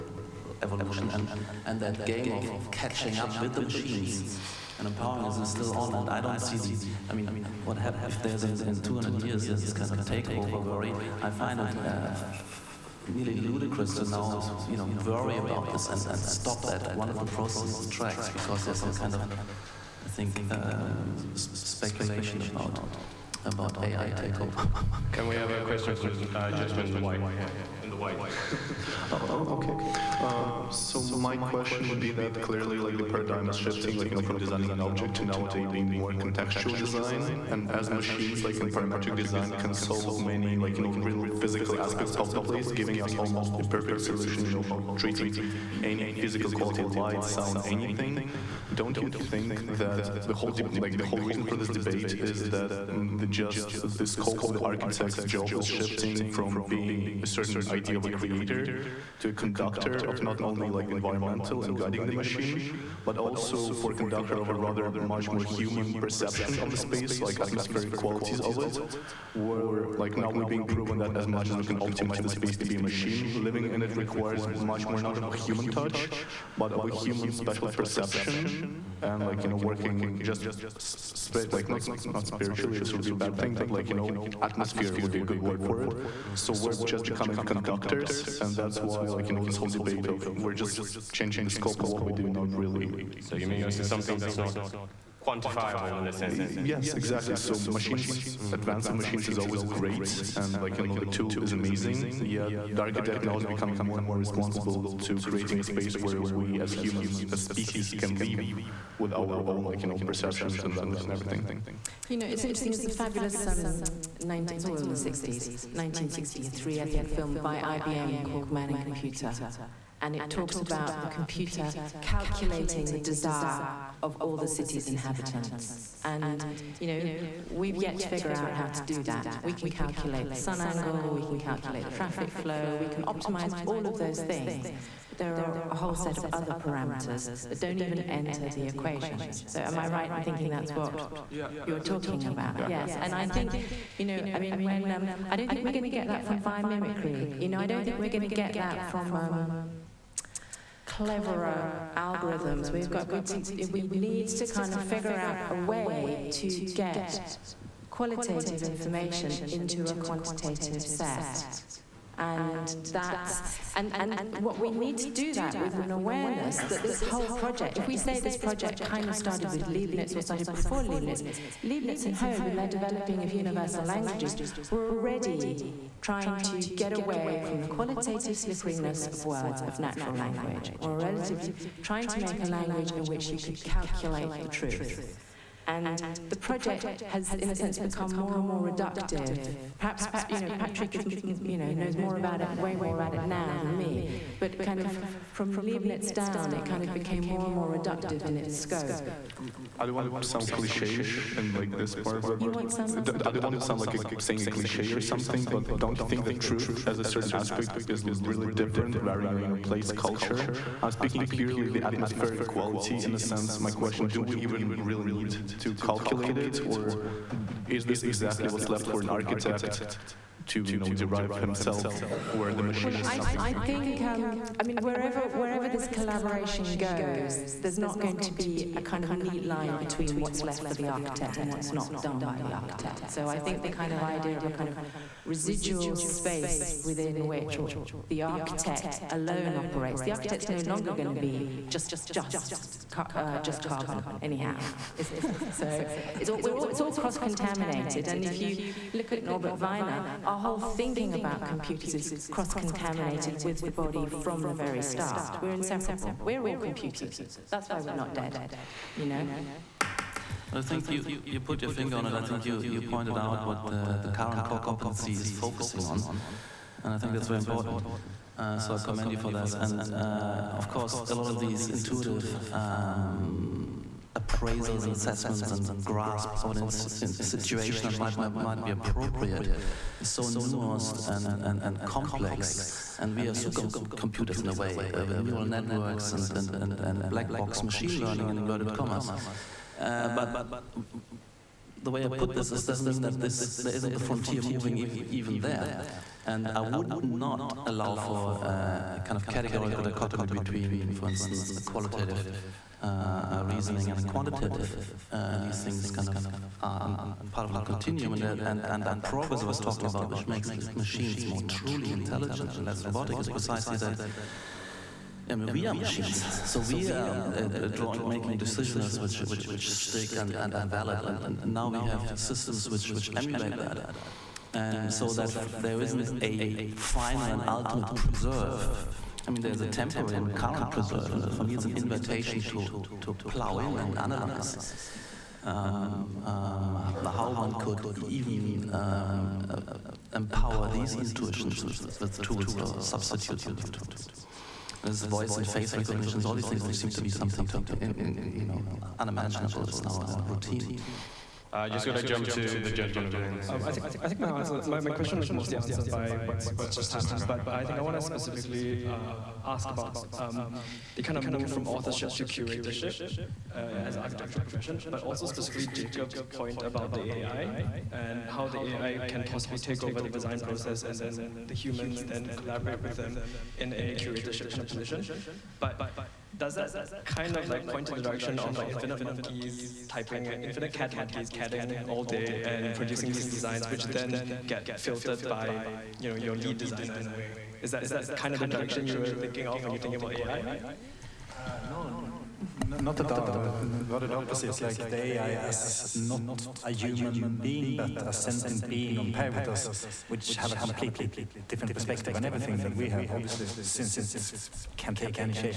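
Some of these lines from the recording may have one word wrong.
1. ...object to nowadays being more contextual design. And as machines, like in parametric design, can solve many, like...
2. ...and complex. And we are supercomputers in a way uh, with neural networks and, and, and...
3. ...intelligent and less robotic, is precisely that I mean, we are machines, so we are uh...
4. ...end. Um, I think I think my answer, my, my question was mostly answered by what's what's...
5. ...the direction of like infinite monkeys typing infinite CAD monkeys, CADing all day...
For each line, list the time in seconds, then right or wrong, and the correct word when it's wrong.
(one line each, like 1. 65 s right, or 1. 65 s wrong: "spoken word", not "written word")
1. 34 s right
2. 281 s right
3. 311 s right
4. 353 s right
5. 377 s right.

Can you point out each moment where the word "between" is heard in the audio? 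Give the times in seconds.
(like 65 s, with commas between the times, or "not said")
229 s, 300 s.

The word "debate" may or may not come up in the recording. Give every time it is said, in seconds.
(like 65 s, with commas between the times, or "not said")
51 s, 89 s.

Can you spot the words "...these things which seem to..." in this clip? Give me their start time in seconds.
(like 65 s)
346 s.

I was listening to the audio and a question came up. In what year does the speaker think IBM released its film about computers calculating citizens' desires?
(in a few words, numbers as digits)
1963.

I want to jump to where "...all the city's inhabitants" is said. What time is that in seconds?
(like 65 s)
124 s.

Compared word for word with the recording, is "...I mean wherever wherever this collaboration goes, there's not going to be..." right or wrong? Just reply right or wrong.
right.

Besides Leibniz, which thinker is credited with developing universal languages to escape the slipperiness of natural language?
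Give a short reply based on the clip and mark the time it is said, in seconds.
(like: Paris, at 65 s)
Hobbes, at 172 s.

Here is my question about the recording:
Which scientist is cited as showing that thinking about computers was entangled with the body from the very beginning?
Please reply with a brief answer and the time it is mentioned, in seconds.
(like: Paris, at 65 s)
Norbert Wiener, at 249 s.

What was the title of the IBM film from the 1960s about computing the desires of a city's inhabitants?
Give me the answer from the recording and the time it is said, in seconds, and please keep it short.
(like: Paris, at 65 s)
Man and Computer, at 118 s.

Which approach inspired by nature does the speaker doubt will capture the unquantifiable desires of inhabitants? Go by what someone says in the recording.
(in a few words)
biomimicry.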